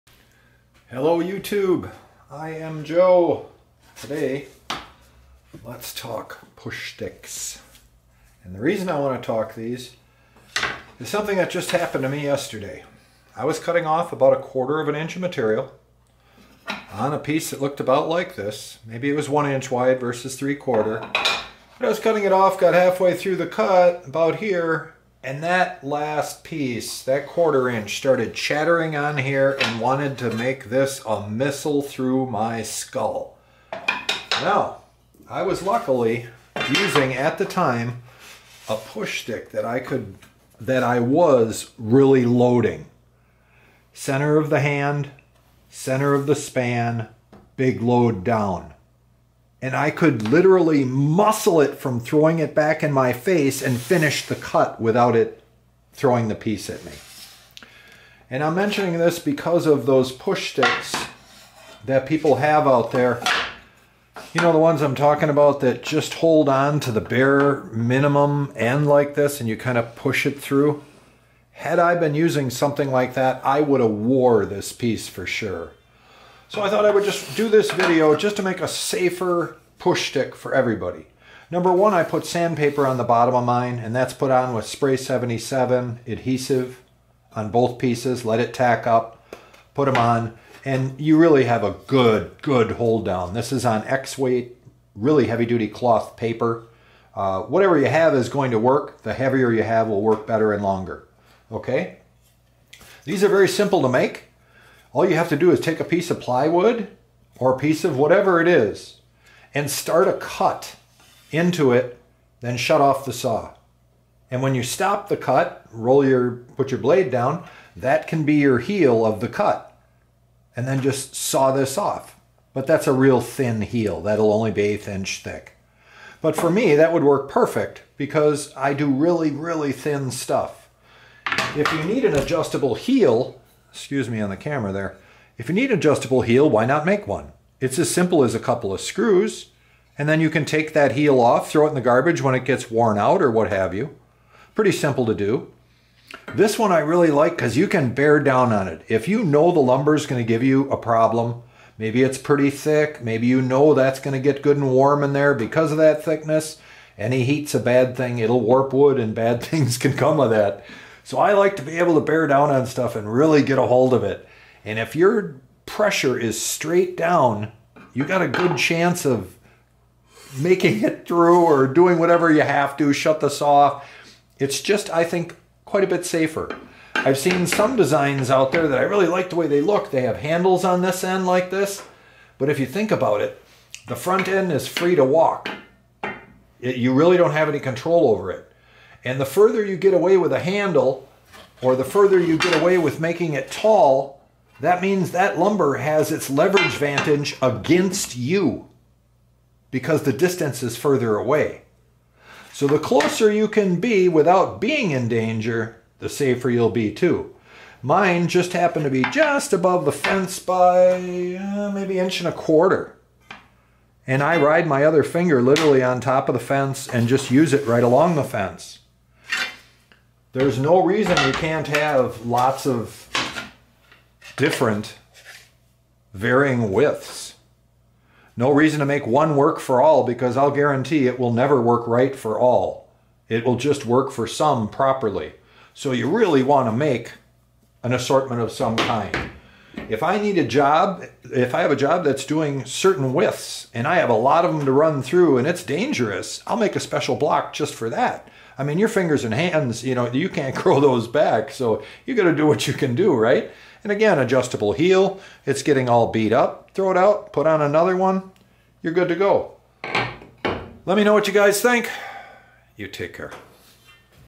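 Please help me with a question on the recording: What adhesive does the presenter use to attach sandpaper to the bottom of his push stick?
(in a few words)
Spray 77.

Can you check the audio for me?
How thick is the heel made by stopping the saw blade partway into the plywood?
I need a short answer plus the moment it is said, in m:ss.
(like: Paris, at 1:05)
1/8 inch, at 2:04.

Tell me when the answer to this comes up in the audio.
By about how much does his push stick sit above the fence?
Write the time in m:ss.
3:31.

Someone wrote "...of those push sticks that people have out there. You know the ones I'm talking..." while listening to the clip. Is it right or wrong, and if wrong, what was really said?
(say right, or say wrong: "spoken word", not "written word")
right.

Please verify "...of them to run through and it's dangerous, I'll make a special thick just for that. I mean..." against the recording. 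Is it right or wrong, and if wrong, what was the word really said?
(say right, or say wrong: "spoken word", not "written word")
wrong: "block", not "thick".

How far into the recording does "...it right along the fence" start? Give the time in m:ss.
3:37.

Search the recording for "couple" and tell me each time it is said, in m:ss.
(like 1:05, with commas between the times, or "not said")
2:18.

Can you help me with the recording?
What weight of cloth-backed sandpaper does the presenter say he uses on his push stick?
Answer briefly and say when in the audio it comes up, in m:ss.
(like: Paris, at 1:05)
X weight, at 1:33.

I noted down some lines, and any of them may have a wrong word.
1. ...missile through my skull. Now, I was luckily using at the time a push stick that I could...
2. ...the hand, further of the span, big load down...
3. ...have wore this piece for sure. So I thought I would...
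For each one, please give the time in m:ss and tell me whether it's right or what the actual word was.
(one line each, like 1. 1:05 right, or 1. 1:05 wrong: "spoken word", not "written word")
1. 0:31 right
2. 0:44 wrong: "center", not "further"
3. 1:13 right.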